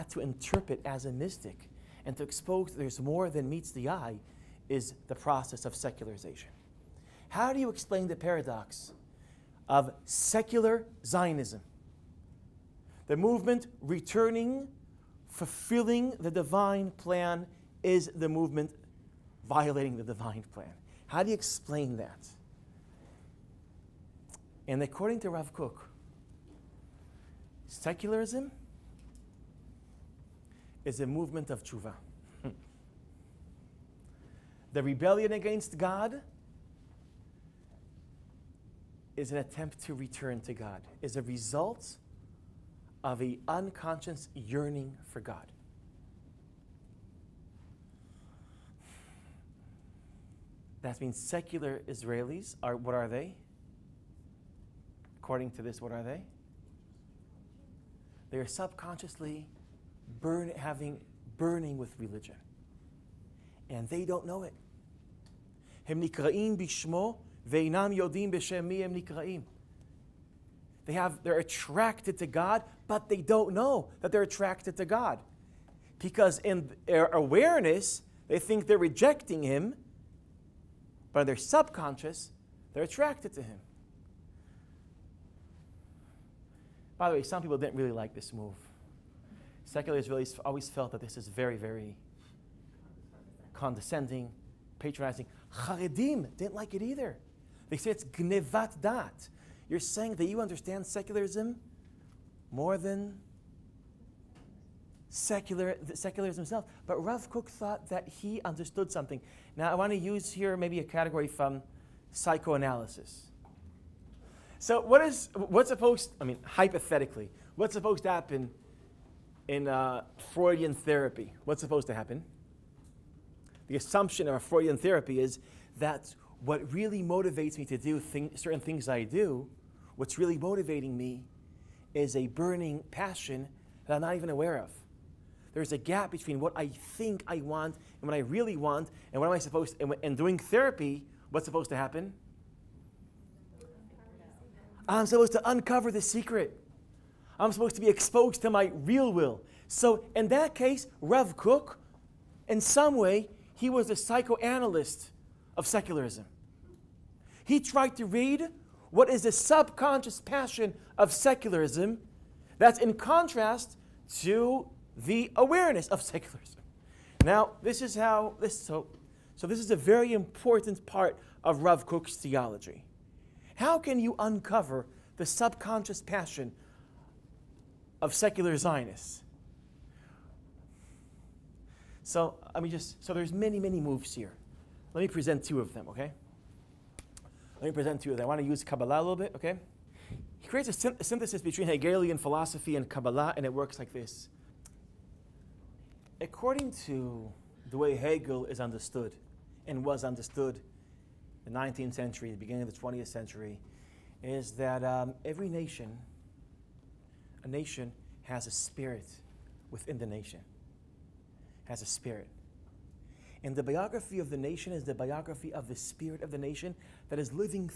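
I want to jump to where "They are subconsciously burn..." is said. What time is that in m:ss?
0:58.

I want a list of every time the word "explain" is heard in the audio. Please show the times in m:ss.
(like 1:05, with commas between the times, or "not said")
0:07, 0:21.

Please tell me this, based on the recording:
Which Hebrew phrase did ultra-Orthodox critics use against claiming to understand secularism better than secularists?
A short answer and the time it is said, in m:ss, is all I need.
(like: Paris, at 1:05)
gnevat dat, at 1:38.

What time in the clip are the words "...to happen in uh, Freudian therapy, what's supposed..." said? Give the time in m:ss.
1:58.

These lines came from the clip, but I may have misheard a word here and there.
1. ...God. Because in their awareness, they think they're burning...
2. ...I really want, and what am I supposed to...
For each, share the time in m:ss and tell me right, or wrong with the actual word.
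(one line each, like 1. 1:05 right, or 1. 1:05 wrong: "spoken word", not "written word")
1. 1:14 wrong: "rejecting", not "burning"
2. 2:18 right.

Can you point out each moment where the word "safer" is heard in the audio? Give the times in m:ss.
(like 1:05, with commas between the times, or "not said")
not said.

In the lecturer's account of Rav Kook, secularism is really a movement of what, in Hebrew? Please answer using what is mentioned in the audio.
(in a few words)
tshuva.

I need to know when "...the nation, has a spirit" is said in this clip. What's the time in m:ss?
3:29.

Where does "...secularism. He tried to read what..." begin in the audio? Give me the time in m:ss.
2:35.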